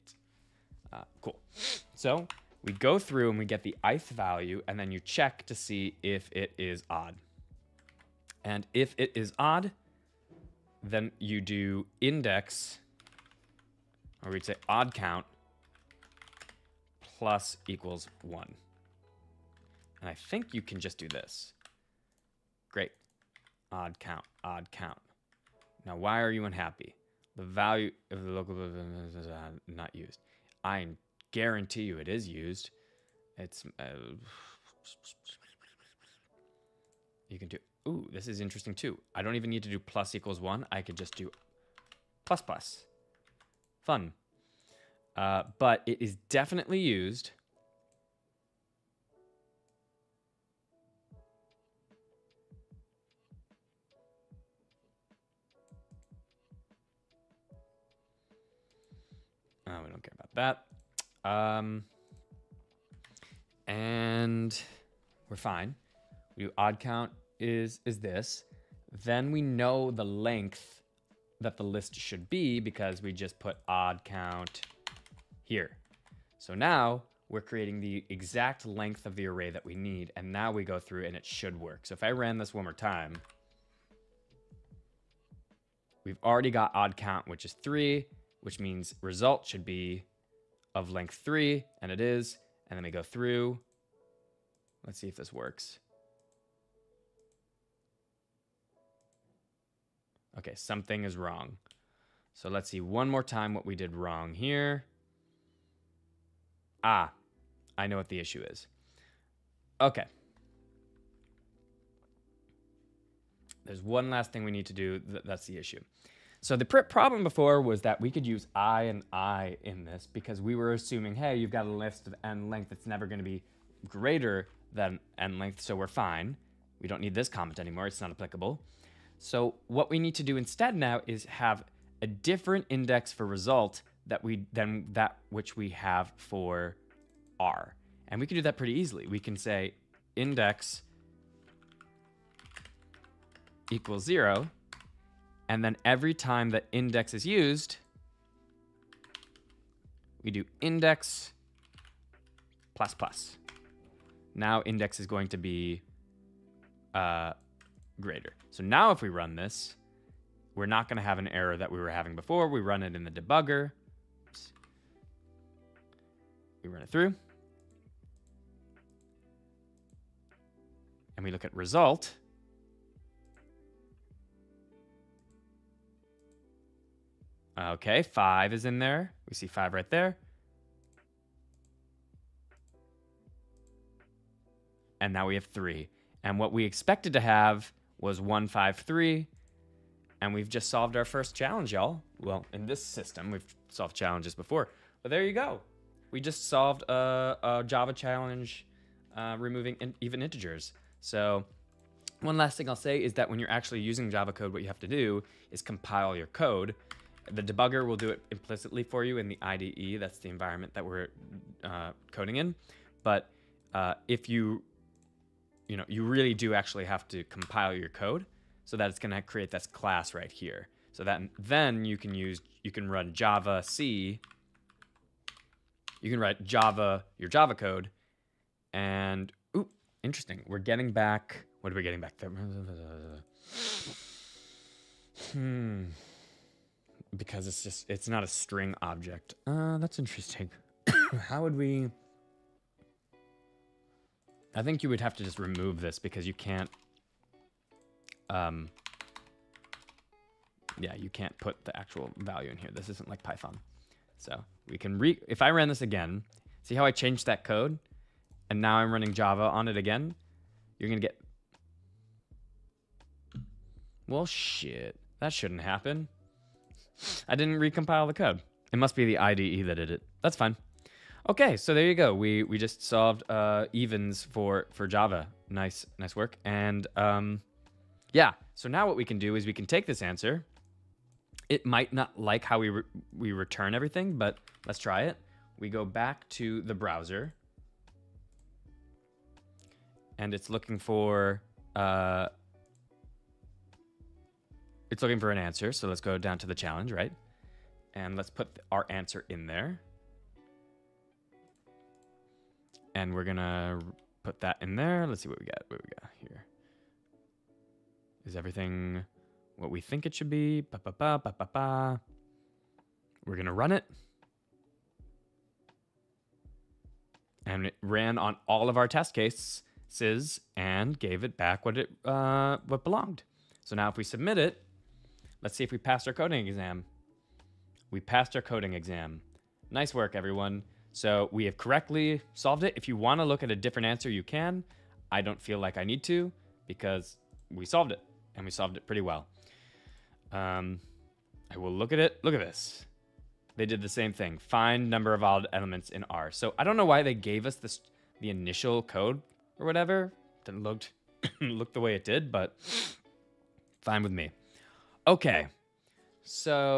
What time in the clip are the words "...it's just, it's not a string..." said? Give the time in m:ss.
3:57.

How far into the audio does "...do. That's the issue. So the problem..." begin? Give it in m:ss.
1:54.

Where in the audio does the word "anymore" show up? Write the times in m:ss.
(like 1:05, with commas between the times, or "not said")
2:07.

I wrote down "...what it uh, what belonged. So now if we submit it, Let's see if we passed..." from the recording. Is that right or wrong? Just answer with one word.
right.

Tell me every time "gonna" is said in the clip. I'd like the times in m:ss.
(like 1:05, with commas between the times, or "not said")
5:03, 5:13.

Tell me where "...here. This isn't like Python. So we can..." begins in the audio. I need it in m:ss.
4:12.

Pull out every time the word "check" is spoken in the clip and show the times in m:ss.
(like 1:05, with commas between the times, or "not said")
0:04.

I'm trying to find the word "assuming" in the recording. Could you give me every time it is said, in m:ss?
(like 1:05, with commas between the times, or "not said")
2:00.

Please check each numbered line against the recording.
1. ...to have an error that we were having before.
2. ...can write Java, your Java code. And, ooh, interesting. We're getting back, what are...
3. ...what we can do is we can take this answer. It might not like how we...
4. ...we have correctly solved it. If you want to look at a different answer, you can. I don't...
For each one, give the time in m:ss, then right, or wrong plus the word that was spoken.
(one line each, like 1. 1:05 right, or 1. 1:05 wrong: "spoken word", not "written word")
1. 2:40 right
2. 3:46 right
3. 4:38 right
4. 5:31 right.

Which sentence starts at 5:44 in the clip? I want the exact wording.
Find number of odd elements in R.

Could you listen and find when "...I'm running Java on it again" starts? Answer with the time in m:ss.
4:18.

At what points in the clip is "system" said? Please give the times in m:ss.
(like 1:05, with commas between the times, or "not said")
3:12.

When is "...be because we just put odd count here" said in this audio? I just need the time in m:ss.
1:12.